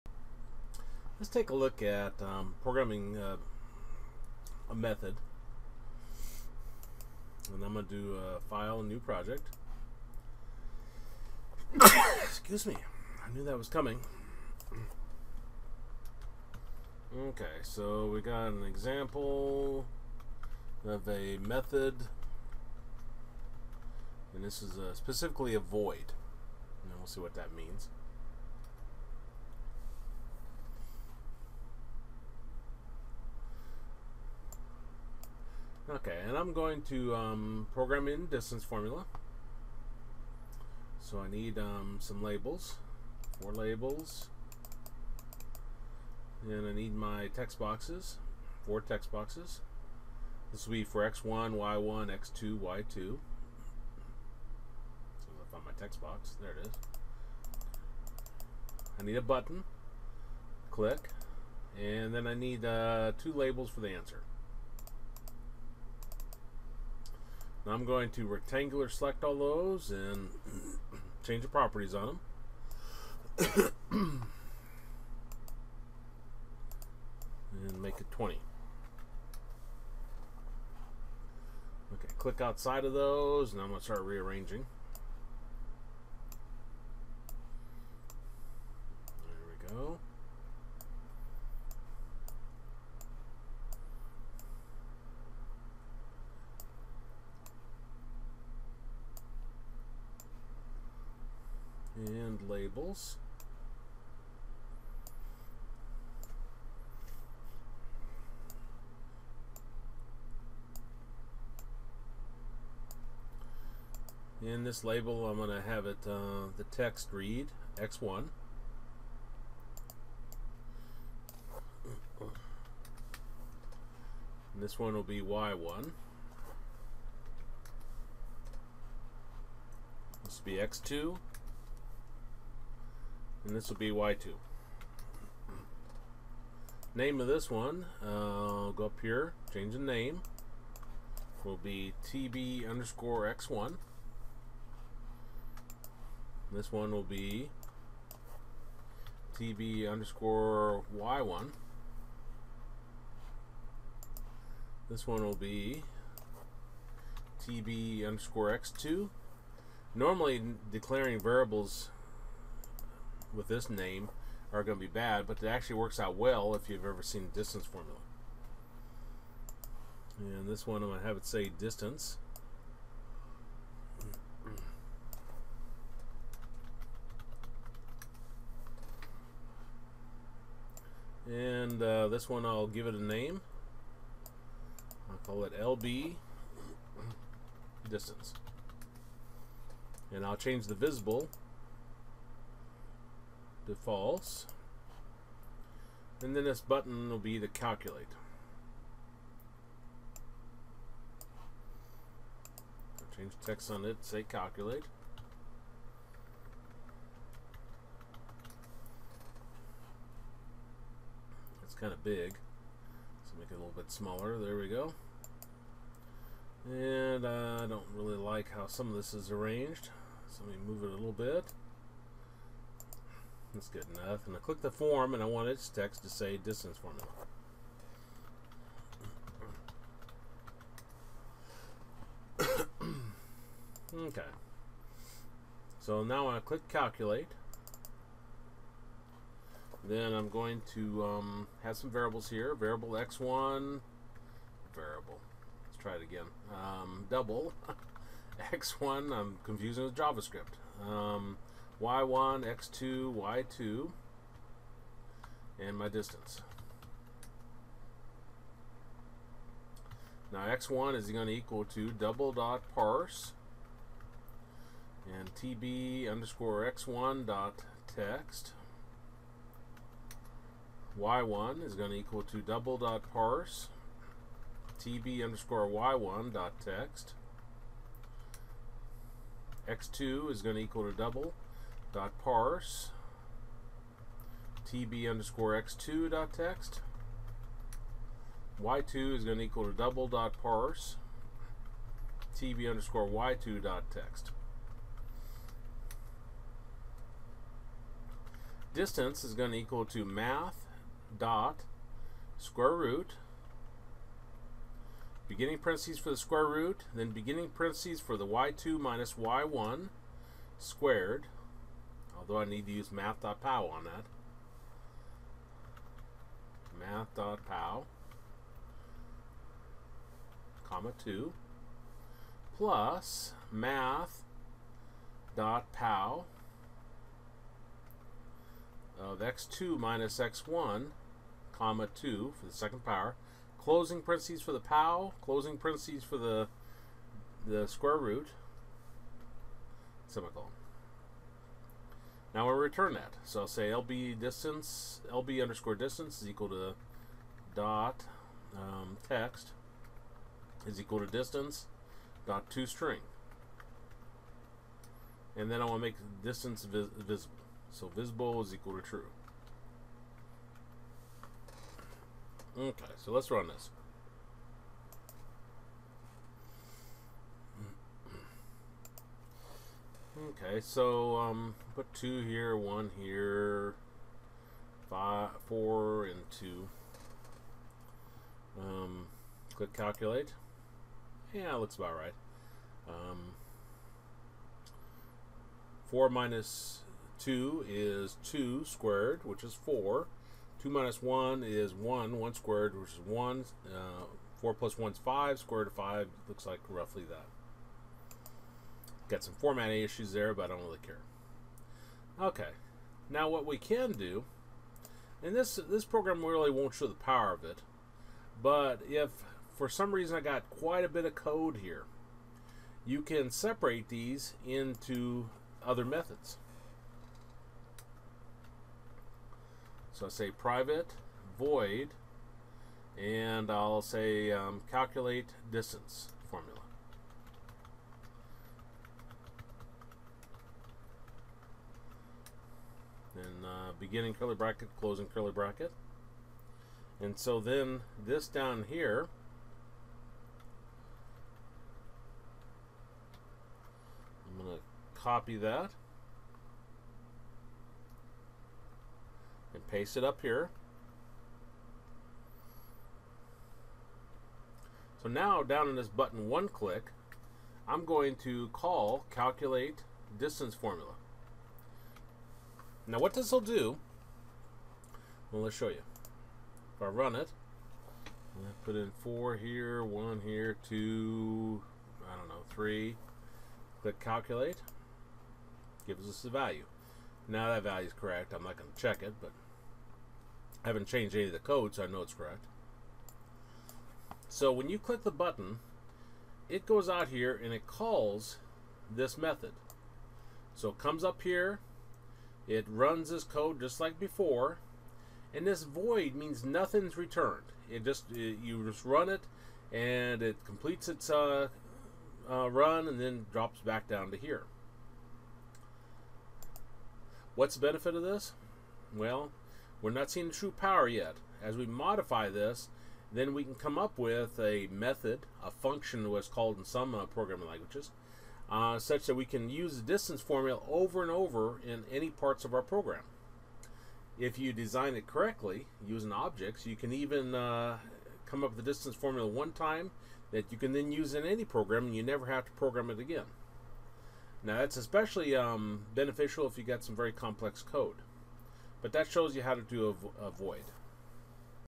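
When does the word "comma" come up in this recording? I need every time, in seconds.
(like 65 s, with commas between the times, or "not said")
320 s, 331 s.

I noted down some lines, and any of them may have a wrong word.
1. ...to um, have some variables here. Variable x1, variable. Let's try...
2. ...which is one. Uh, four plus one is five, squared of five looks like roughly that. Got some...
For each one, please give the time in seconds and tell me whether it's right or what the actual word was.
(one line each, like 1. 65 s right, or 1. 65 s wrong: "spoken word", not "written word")
1. 240 s right
2. 392 s right.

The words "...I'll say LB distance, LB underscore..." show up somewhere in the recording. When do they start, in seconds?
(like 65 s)
343 s.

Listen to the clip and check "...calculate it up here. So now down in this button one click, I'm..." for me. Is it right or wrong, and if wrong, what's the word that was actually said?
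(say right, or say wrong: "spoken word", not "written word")
wrong: "paste", not "calculate".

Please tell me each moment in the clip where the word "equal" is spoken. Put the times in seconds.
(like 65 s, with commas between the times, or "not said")
261 s, 271 s, 280 s, 289 s, 299 s, 346 s, 350 s, 358 s.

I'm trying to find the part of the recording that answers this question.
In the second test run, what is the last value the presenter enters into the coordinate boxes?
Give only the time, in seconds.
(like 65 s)
472 s.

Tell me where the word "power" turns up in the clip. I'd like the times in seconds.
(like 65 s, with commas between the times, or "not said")
332 s, 406 s, 510 s.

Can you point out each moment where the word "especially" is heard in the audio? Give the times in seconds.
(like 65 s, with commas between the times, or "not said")
534 s.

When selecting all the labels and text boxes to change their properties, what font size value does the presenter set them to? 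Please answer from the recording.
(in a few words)
20.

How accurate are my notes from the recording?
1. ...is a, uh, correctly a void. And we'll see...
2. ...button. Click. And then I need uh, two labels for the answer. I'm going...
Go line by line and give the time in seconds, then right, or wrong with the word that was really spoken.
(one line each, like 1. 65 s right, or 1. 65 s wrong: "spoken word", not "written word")
1. 24 s wrong: "specifically", not "correctly"
2. 59 s right.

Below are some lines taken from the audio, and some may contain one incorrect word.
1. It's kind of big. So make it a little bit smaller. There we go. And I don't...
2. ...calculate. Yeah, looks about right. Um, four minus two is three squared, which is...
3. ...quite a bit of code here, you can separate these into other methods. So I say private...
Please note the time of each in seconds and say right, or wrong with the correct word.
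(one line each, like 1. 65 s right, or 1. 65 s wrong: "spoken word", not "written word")
1. 211 s right
2. 379 s wrong: "two", not "three"
3. 410 s right.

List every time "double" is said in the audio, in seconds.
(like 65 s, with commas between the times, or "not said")
247 s, 261 s, 272 s, 280 s, 289 s.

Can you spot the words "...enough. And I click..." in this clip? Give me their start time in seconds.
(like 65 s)
223 s.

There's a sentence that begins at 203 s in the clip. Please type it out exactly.
change text on it, say calculate.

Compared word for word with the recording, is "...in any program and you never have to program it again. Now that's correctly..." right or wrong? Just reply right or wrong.
wrong.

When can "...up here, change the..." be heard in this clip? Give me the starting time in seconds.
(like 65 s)
138 s.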